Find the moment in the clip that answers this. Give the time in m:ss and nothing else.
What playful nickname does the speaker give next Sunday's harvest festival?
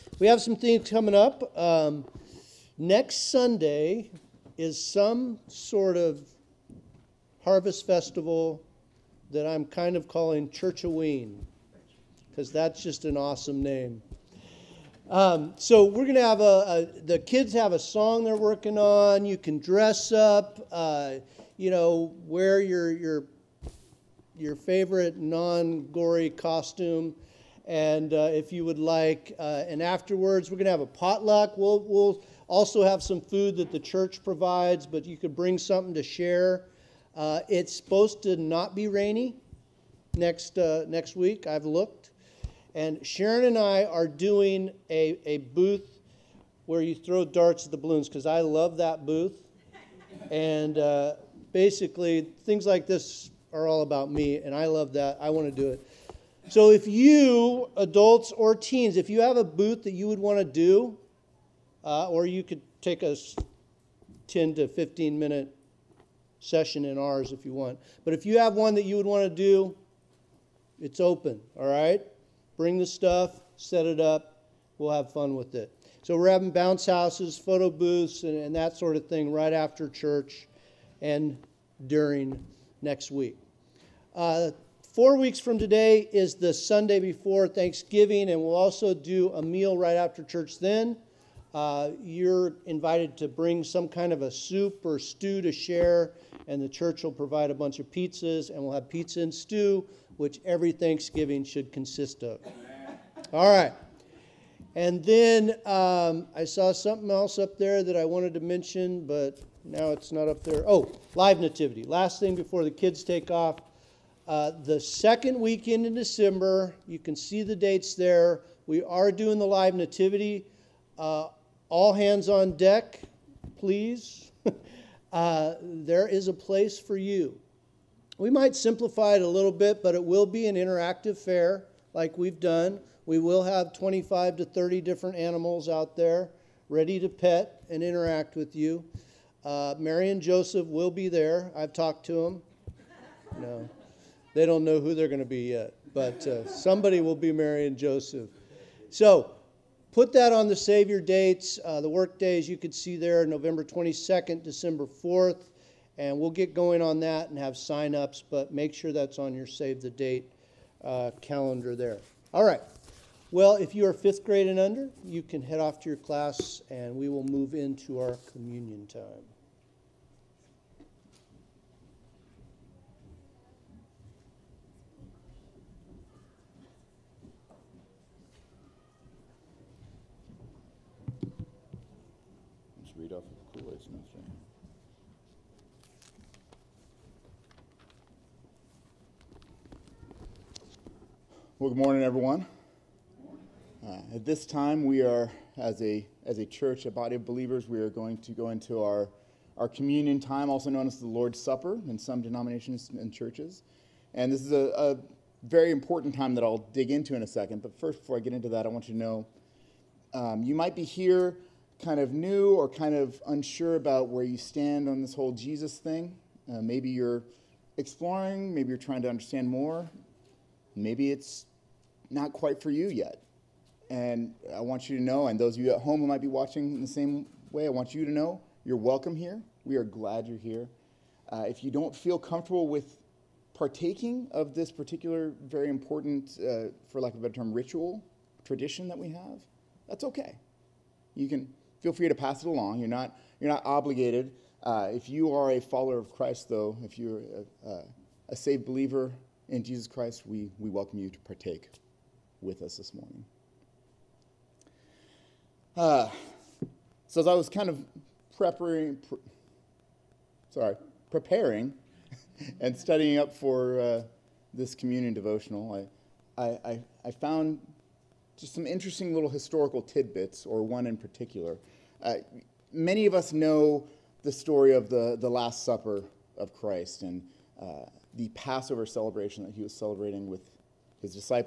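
0:10.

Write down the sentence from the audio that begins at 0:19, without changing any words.
You can dress up, uh, you know, wear your your your favorite non-gory costume.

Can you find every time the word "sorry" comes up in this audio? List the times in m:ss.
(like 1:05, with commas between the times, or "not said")
4:20.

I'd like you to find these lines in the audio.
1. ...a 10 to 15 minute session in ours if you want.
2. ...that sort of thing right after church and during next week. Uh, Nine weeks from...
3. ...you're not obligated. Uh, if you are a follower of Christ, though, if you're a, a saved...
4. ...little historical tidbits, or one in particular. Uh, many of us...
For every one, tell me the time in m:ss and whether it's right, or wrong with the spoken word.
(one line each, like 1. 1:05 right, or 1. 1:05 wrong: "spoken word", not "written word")
1. 1:03 right
2. 1:18 wrong: "Four", not "Nine"
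3. 4:03 right
4. 4:29 right.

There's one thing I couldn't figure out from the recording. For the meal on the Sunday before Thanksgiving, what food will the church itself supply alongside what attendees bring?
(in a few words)
Pizzas.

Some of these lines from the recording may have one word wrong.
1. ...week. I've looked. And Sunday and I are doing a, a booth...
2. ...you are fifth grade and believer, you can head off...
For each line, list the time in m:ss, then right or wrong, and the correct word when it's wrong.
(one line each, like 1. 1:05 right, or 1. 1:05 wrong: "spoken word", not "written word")
1. 0:41 wrong: "Sharon", not "Sunday"
2. 2:43 wrong: "under", not "believer".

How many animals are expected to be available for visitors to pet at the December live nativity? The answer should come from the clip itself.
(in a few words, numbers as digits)
25 to 30.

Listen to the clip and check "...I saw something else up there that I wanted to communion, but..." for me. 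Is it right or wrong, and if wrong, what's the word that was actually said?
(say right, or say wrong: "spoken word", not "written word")
wrong: "mention", not "communion".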